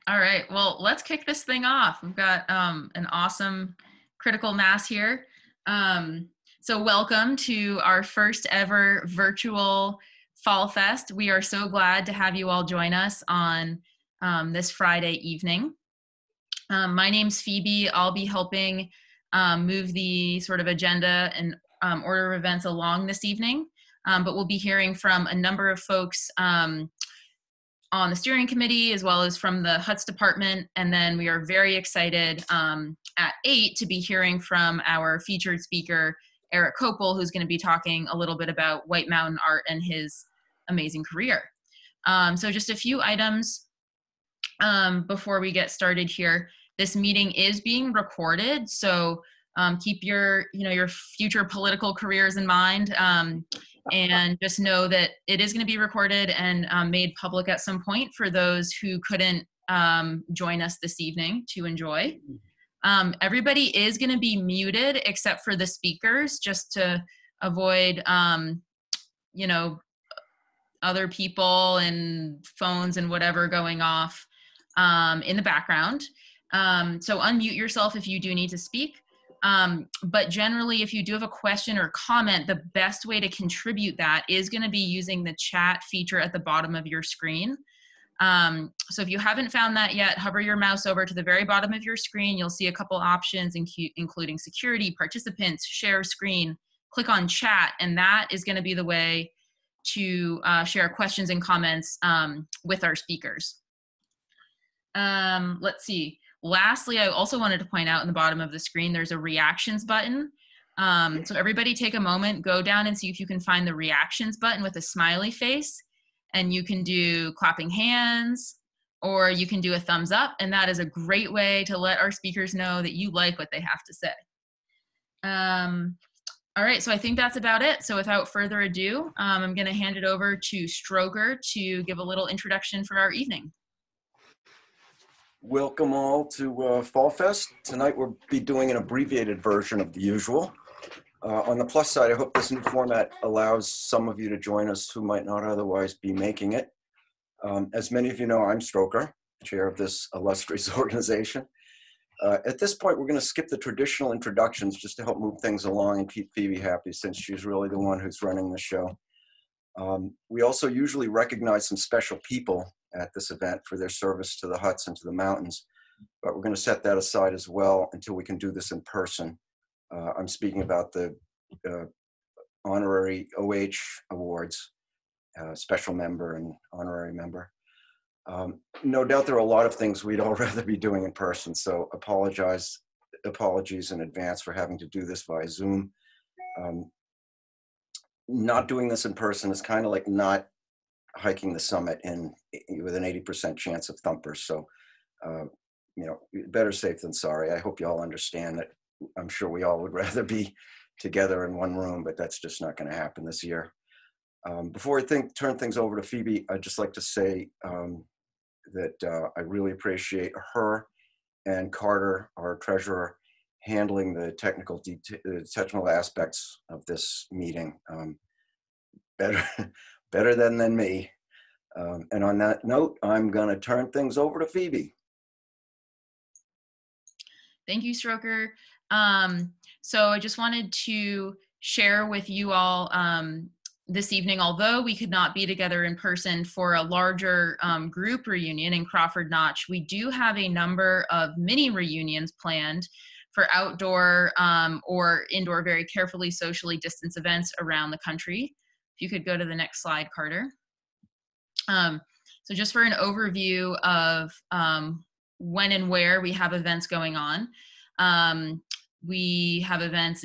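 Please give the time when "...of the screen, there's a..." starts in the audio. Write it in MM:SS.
01:48.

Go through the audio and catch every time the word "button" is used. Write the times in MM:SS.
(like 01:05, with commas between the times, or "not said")
01:49, 01:54.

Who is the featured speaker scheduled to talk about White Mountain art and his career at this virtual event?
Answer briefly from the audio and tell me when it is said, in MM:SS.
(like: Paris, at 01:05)
Erik Koeppel, at 00:36.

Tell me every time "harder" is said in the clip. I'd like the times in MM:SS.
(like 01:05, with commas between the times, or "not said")
not said.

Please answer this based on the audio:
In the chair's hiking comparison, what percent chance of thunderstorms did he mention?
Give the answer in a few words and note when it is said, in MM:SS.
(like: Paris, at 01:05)
80%, at 03:13.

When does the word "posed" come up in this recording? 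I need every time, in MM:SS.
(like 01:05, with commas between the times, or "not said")
not said.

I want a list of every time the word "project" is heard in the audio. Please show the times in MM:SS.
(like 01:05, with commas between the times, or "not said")
not said.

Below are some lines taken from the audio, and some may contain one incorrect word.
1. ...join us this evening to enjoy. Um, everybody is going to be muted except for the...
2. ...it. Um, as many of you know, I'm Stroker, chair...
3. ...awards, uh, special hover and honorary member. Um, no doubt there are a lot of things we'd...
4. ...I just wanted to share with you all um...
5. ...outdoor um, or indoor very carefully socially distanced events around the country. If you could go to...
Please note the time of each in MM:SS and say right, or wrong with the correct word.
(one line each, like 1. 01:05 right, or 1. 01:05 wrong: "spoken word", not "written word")
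1. 01:00 right
2. 02:26 right
3. 02:54 wrong: "member", not "hover"
4. 03:50 right
5. 04:03 right.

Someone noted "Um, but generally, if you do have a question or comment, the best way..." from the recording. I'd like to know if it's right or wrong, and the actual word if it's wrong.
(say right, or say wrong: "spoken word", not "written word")
right.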